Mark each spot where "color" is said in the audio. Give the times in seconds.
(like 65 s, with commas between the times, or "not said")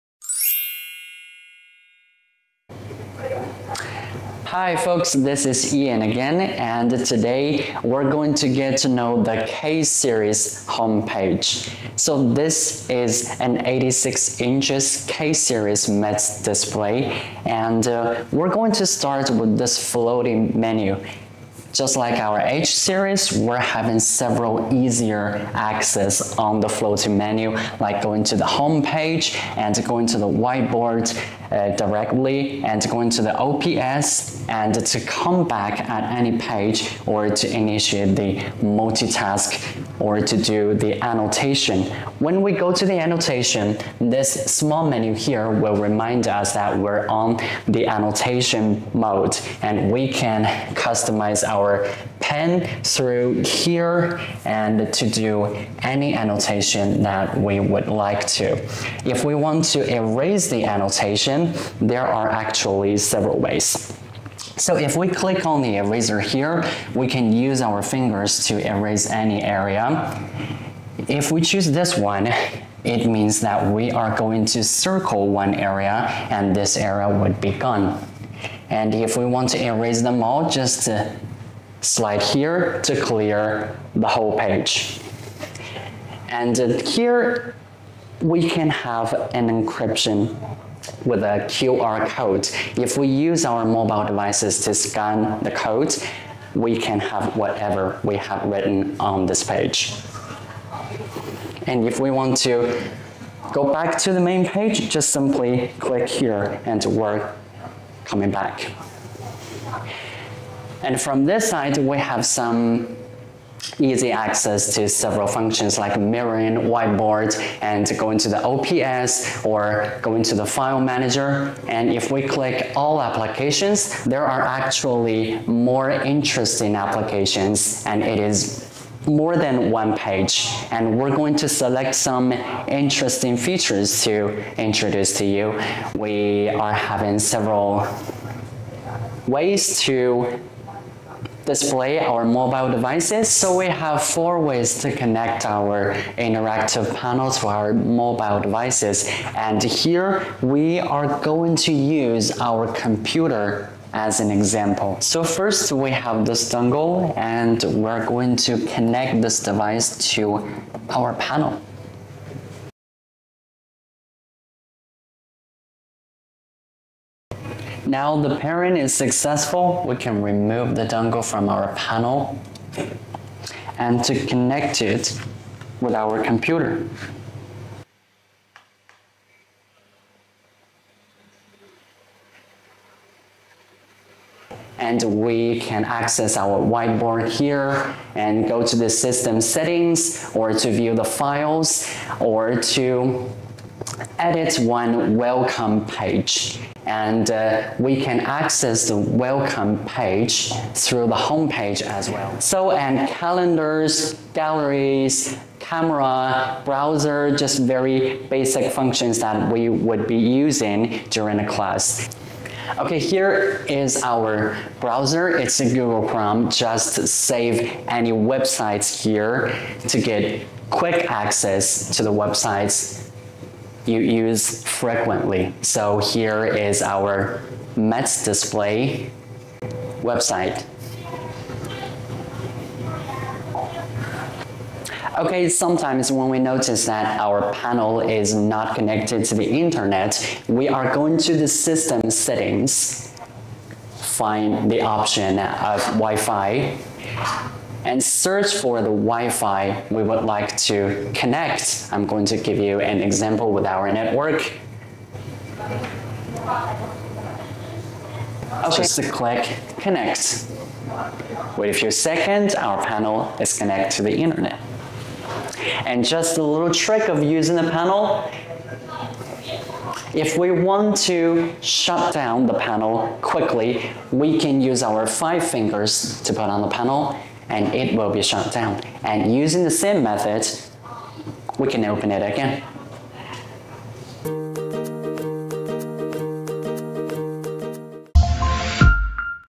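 not said.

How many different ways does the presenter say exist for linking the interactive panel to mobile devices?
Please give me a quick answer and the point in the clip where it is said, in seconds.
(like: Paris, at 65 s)
4, at 144 s.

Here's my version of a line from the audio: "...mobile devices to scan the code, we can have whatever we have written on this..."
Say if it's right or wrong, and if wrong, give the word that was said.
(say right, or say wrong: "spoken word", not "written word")
right.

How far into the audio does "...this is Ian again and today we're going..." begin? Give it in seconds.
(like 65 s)
5 s.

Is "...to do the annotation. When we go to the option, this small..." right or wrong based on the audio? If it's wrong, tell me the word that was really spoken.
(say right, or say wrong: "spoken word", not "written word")
wrong: "annotation", not "option".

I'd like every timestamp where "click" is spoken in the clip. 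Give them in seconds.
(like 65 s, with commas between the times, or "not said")
65 s, 105 s, 122 s, 259 s.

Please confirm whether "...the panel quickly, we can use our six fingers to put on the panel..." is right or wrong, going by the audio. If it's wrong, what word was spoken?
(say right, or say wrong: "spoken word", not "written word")
wrong: "five", not "six".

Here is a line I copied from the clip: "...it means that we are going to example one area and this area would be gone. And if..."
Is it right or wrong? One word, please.
wrong.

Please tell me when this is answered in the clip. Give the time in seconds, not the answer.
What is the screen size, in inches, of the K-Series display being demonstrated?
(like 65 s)
13 s.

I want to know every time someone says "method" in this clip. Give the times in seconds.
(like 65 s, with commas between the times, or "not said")
280 s.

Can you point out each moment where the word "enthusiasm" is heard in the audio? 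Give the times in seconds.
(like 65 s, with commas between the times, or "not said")
not said.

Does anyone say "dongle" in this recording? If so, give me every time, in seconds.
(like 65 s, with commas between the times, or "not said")
156 s, 170 s.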